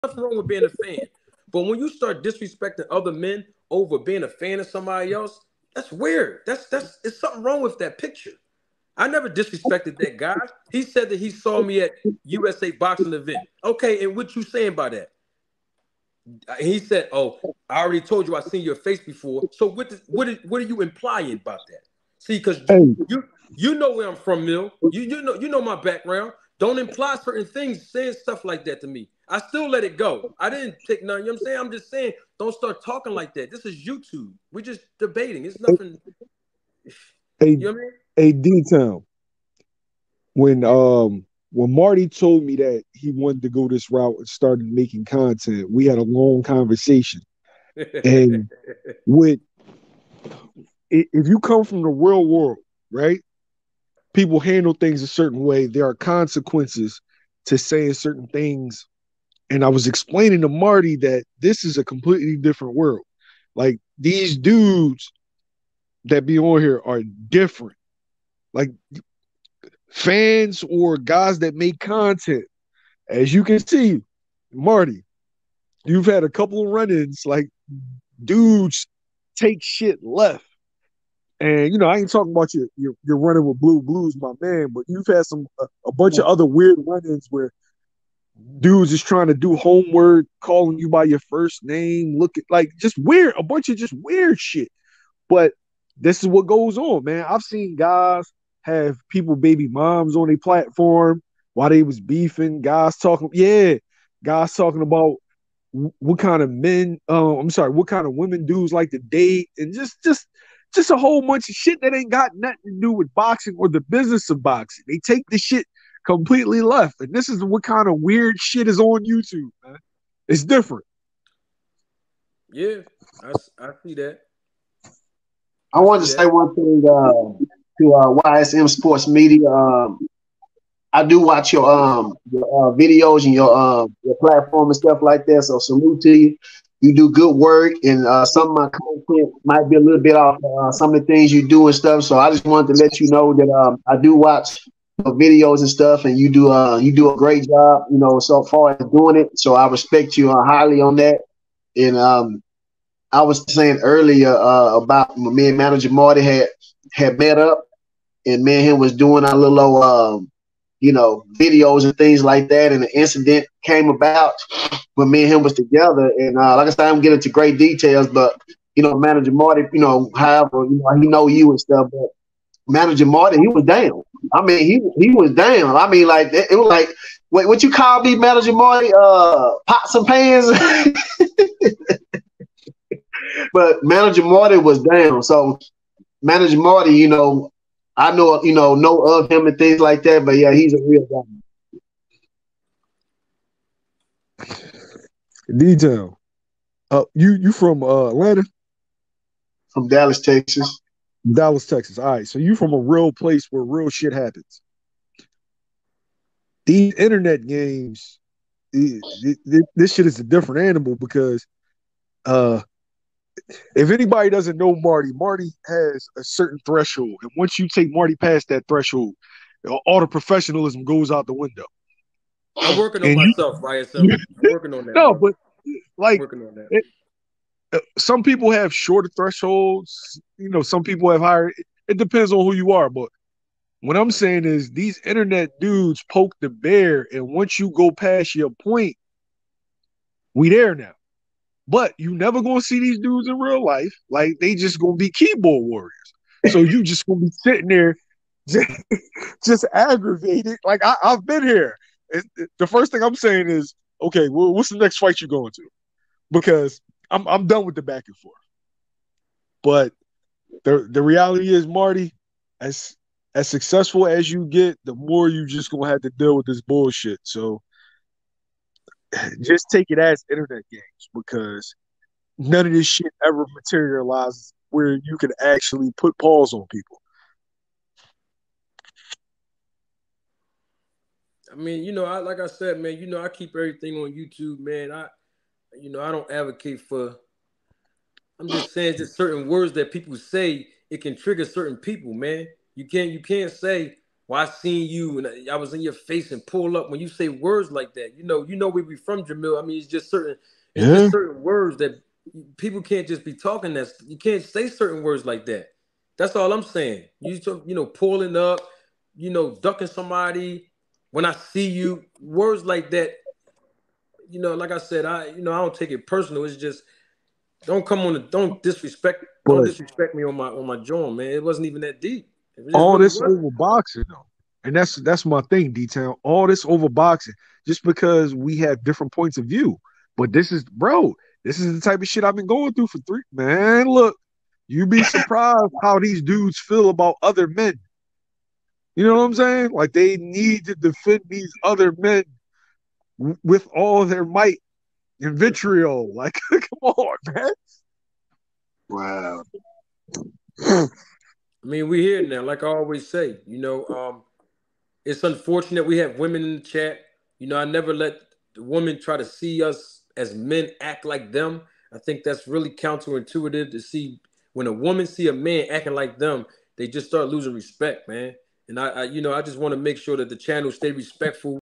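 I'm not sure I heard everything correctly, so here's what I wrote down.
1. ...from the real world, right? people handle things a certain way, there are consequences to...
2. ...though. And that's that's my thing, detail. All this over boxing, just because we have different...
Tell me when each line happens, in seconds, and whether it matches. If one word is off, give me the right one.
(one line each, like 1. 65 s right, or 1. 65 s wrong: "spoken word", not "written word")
1. 51 s right
2. 324 s right.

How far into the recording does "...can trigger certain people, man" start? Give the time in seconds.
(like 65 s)
291 s.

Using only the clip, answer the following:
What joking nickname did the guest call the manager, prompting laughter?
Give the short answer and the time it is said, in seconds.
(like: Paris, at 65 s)
Pots and pans, at 179 s.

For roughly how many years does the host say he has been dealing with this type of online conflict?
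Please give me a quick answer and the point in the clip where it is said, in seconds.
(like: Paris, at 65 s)
Three, at 332 s.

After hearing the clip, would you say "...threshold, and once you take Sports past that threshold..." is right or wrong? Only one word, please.
wrong.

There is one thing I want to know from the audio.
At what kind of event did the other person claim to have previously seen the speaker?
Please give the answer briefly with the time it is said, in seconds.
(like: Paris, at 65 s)
USA Boxing event, at 12 s.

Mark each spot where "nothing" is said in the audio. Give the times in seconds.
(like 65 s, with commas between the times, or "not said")
0 s, 35 s, 112 s.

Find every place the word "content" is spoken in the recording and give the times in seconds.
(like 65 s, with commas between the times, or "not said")
45 s, 71 s, 138 s.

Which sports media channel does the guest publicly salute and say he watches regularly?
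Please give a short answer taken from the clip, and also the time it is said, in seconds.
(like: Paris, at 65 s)
YSM Sports Media, at 128 s.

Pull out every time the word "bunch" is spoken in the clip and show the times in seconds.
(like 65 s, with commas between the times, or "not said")
85 s, 93 s, 111 s.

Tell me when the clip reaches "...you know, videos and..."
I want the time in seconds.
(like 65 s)
160 s.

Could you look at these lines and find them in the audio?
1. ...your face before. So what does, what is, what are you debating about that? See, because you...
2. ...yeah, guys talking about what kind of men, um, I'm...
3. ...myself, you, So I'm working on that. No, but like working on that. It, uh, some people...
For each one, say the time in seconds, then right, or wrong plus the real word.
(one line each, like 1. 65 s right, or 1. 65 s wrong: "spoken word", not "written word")
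1. 18 s wrong: "implying", not "debating"
2. 103 s right
3. 223 s right.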